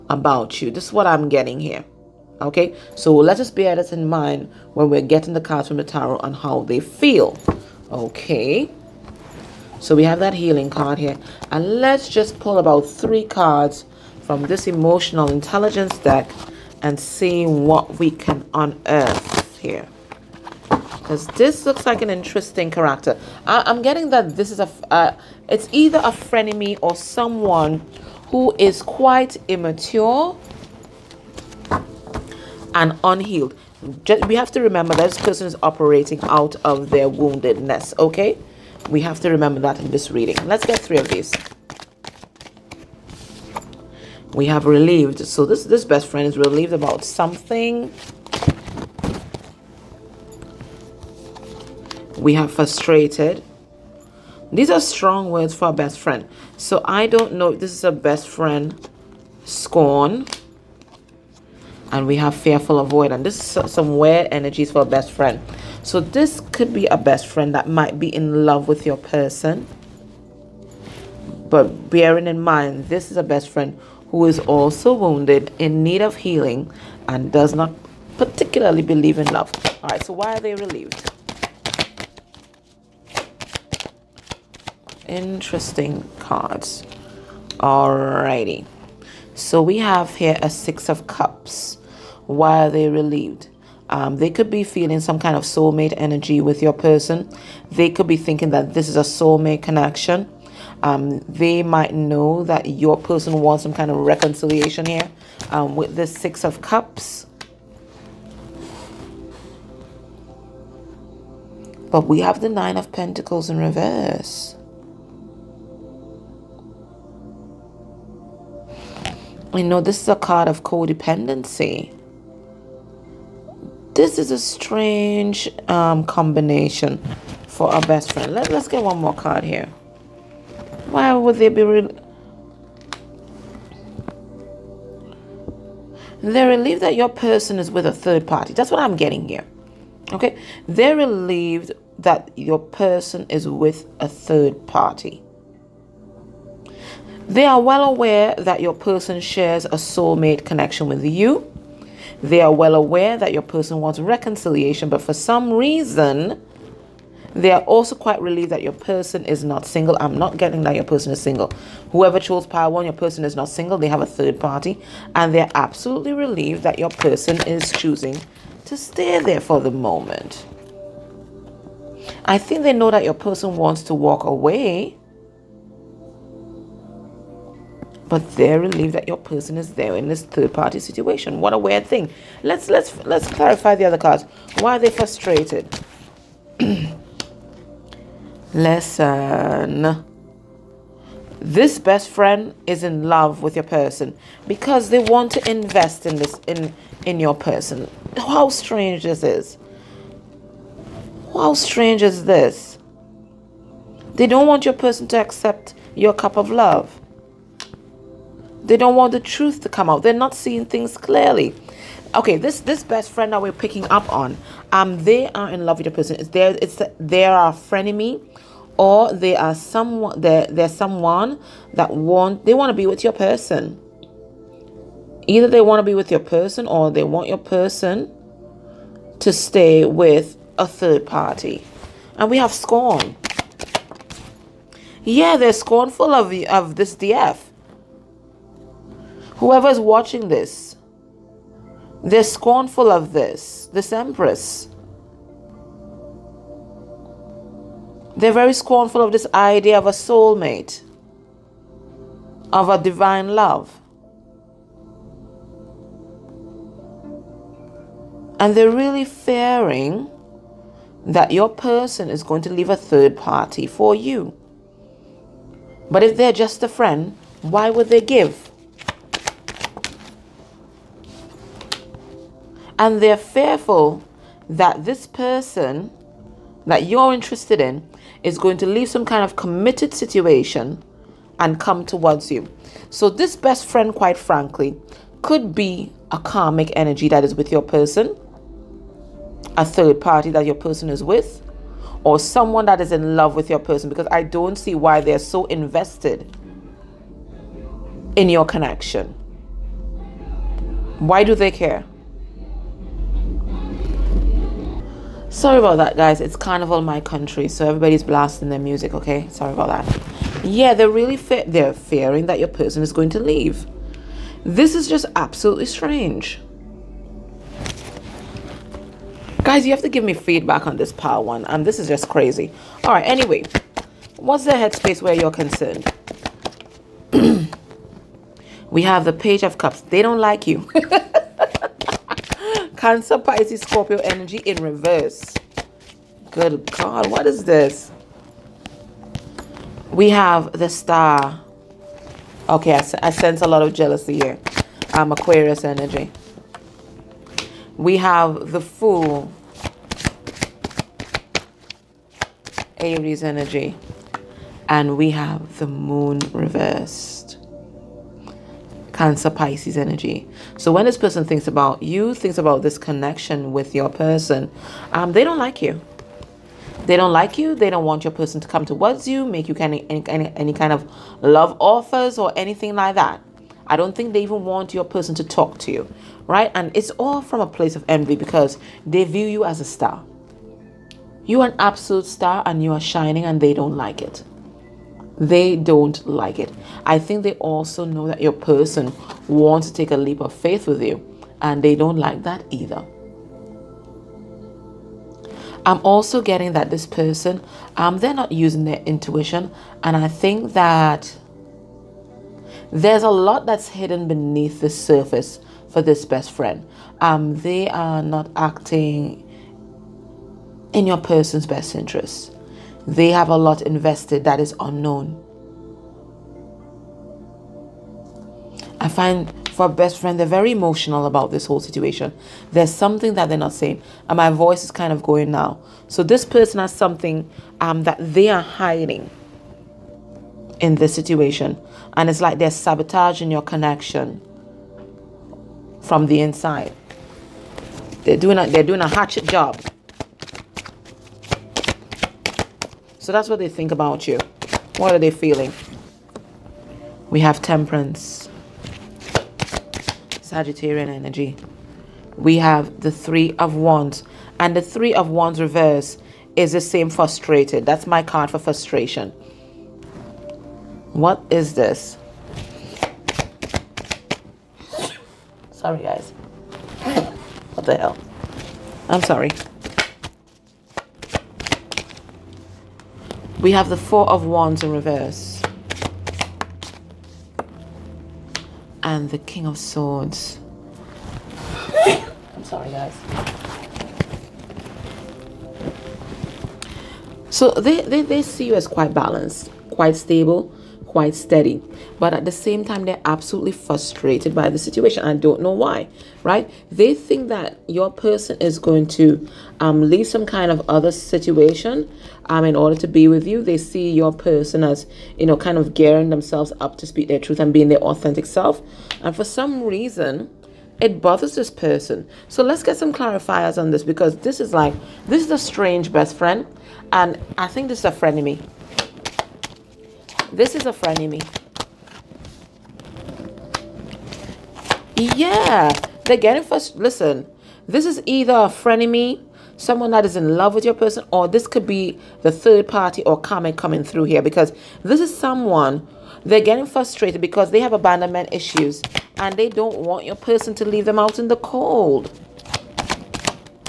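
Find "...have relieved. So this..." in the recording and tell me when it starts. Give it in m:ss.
0:44.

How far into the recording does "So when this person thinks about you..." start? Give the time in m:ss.
6:00.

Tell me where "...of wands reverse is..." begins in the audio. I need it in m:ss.
7:34.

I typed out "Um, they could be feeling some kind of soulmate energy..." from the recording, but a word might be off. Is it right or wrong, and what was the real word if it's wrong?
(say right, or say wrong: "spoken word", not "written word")
right.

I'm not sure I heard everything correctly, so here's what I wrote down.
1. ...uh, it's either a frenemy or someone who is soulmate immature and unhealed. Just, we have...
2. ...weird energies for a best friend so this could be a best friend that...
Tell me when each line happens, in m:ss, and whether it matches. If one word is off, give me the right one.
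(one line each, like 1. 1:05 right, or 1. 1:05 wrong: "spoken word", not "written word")
1. 0:24 wrong: "quite", not "soulmate"
2. 1:03 right.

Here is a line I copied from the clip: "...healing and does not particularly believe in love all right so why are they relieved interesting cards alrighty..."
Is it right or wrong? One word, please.
right.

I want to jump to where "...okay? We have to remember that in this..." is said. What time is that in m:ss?
0:37.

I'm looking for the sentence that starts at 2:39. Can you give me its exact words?
I'm not getting that your person is single.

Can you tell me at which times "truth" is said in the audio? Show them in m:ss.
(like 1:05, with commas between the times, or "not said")
3:29, 8:27.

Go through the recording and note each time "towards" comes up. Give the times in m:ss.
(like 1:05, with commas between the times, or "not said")
4:41, 6:08.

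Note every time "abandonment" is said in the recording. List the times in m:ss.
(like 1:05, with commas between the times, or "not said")
8:57.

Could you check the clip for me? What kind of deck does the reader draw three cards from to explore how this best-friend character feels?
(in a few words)
emotional intelligence deck.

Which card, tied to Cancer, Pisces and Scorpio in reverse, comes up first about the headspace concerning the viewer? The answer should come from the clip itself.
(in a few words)
Page of Cups.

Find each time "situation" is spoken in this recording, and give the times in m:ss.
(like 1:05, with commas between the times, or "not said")
3:00, 4:39, 7:01, 7:10, 8:14, 8:20.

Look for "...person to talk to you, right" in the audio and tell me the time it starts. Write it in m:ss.
6:14.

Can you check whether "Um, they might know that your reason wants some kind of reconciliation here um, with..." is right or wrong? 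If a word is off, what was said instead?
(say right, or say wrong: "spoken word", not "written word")
wrong: "person", not "reason".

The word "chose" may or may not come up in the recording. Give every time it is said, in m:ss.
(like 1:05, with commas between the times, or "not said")
2:42.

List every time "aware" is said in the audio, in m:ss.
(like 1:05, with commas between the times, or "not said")
2:27, 2:32.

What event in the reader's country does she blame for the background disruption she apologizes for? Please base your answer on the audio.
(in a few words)
carnival.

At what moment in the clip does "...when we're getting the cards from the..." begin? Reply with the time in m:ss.
0:04.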